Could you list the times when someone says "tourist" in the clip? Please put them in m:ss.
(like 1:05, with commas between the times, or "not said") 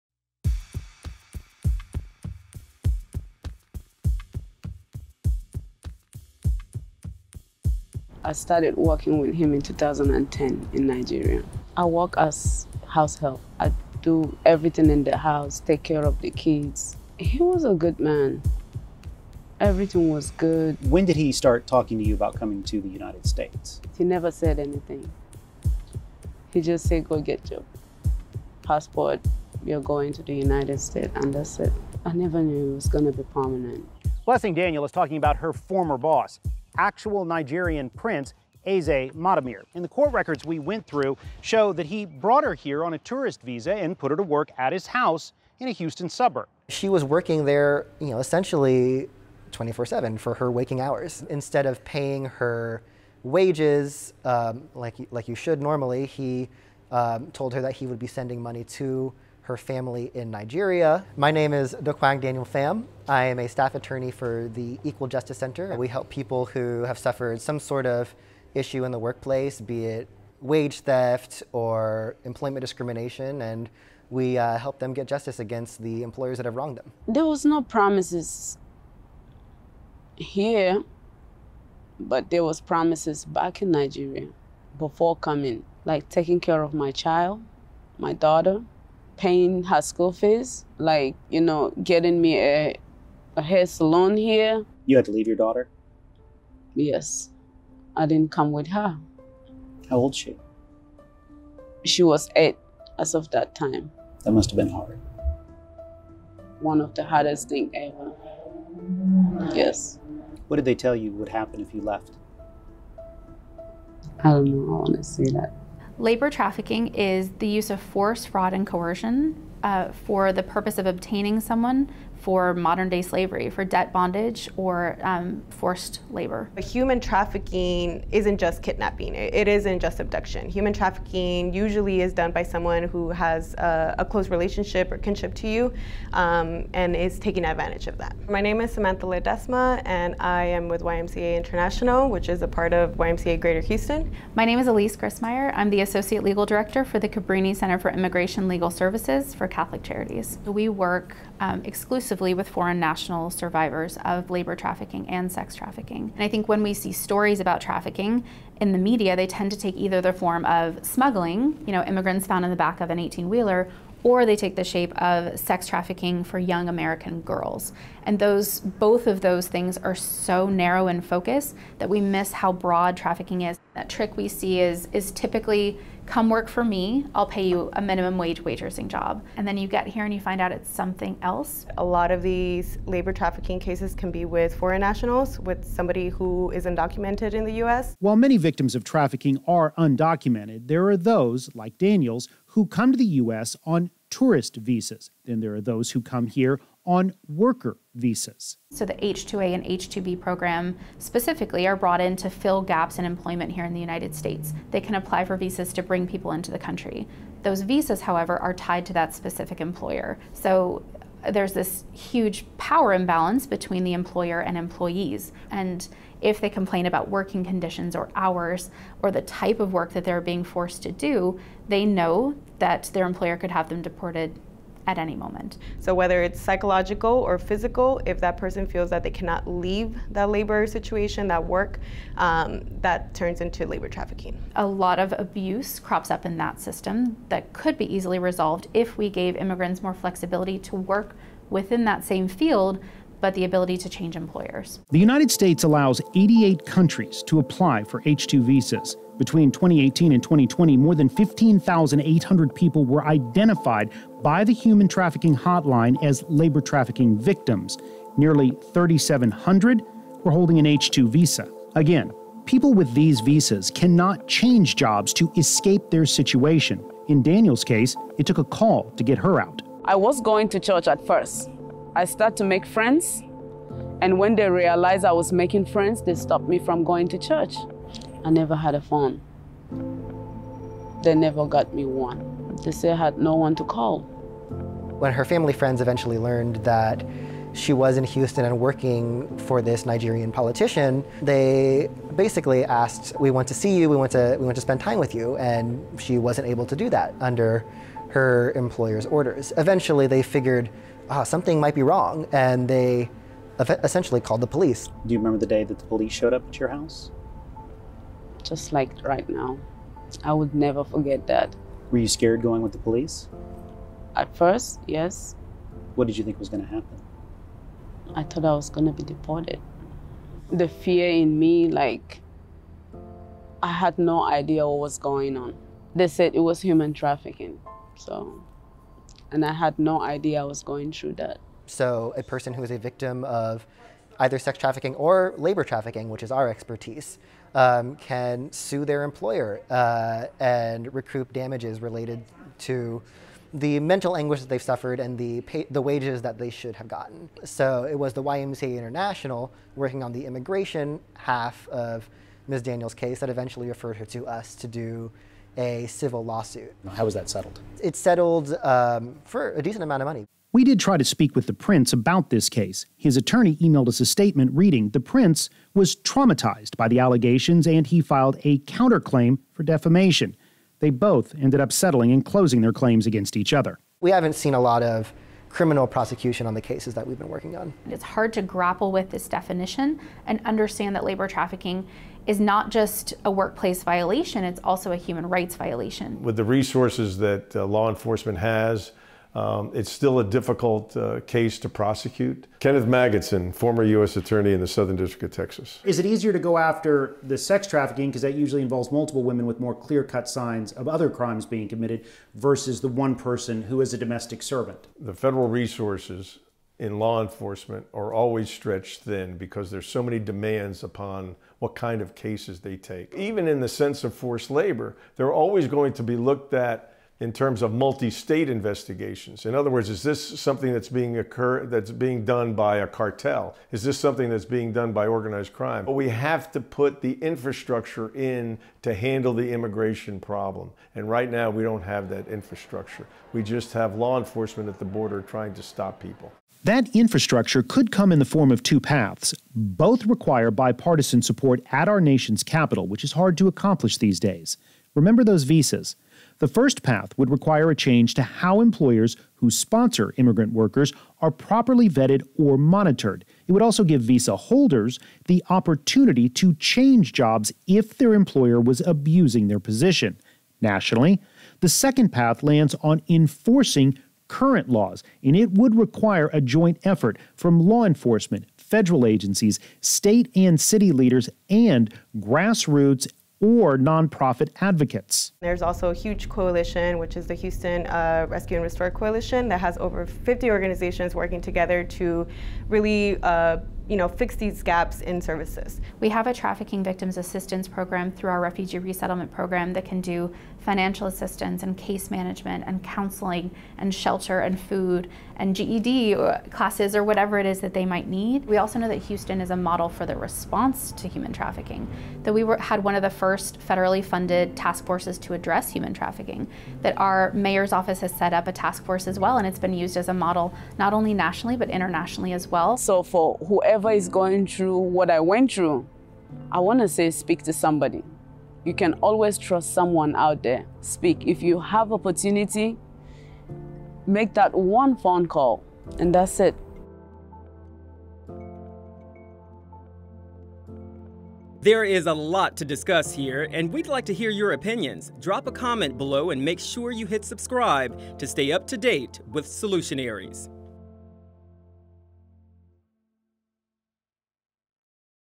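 0:42, 3:14.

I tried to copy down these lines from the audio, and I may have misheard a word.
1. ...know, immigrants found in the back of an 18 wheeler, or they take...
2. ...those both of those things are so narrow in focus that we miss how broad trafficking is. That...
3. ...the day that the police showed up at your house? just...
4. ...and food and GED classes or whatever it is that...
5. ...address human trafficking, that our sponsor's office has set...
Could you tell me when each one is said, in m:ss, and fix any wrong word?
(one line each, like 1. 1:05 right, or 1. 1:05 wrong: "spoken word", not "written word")
1. 2:41 right
2. 2:48 right
3. 5:05 right
4. 8:14 right
5. 8:25 wrong: "mayor", not "sponsor".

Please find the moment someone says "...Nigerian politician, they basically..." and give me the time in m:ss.
4:49.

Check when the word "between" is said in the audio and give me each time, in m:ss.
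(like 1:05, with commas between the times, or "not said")
3:33, 4:09.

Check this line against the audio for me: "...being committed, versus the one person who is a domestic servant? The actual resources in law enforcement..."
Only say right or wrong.
wrong.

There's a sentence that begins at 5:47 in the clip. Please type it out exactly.
So it was the YMCA International working on the immigration half of Ms.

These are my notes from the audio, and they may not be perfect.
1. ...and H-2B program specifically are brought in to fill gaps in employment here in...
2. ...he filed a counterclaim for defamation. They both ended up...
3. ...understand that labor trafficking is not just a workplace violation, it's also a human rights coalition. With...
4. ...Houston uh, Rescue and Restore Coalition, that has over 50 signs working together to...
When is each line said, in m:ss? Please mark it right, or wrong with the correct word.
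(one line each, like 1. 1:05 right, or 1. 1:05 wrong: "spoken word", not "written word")
1. 3:19 right
2. 6:07 right
3. 6:20 wrong: "violation", not "coalition"
4. 7:57 wrong: "organizations", not "signs".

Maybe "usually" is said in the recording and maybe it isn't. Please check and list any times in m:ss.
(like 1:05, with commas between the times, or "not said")
2:11, 6:38.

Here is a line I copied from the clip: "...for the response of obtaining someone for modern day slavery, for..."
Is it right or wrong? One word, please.
wrong.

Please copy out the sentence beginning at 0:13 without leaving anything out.
I do everything in the house, take care of the kids.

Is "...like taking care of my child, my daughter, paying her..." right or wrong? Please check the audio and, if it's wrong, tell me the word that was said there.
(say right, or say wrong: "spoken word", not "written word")
right.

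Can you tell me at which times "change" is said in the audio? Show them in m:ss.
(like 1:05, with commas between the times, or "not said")
4:03, 4:24, 7:27, 7:36.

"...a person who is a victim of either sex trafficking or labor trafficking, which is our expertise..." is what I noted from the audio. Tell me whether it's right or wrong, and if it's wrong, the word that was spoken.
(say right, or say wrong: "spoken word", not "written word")
right.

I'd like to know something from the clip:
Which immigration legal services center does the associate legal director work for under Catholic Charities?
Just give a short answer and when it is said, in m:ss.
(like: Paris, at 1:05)
Cabrini Center, at 2:27.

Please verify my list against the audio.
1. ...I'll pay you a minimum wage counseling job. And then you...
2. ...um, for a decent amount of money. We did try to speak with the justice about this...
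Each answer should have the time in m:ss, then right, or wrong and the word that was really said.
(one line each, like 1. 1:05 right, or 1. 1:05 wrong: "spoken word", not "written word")
1. 2:57 wrong: "waitressing", not "counseling"
2. 5:58 wrong: "prince", not "justice".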